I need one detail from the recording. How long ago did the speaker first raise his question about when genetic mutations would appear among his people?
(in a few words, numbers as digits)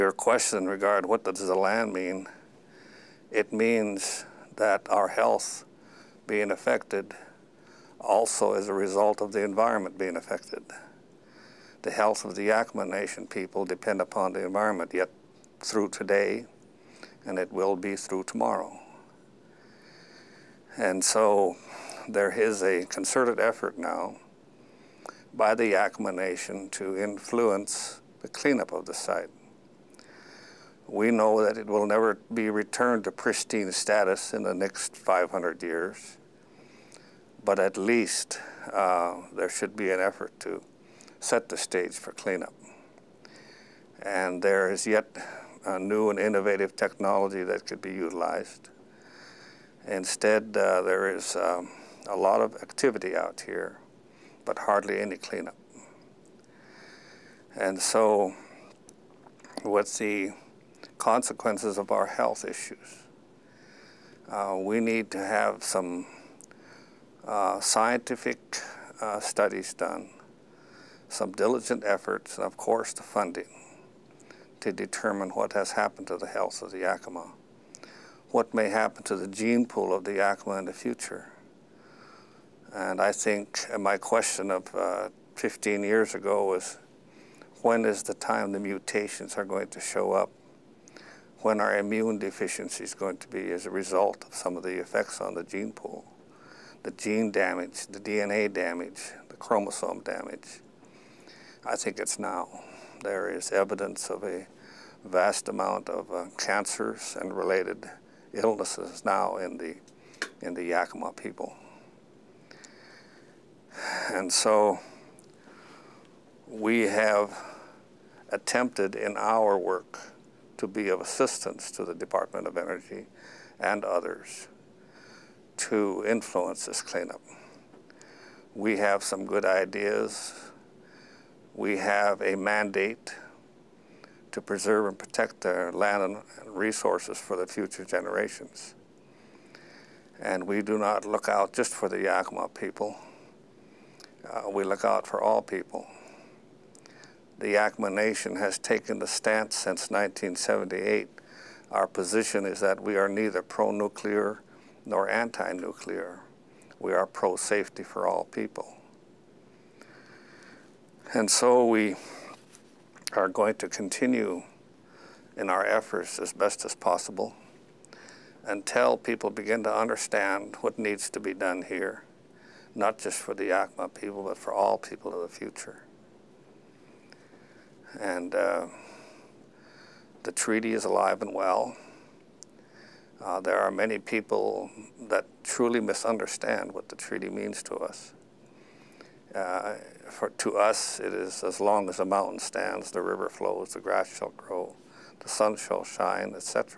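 15 years ago.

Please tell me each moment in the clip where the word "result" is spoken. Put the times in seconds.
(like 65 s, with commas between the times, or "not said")
8 s, 93 s.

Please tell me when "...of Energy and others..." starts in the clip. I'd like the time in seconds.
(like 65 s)
122 s.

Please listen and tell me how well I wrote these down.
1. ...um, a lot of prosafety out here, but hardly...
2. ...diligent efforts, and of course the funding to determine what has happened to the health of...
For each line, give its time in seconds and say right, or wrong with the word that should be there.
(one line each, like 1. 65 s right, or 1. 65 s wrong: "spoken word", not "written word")
1. 51 s wrong: "activity", not "prosafety"
2. 71 s right.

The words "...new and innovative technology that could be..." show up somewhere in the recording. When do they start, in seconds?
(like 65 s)
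45 s.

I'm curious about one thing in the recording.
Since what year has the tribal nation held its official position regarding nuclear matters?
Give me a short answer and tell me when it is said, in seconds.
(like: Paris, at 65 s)
1978, at 149 s.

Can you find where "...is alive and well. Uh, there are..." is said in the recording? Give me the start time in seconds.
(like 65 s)
180 s.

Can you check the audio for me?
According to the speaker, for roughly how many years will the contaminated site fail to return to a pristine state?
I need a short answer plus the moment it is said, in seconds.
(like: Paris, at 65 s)
500 years, at 34 s.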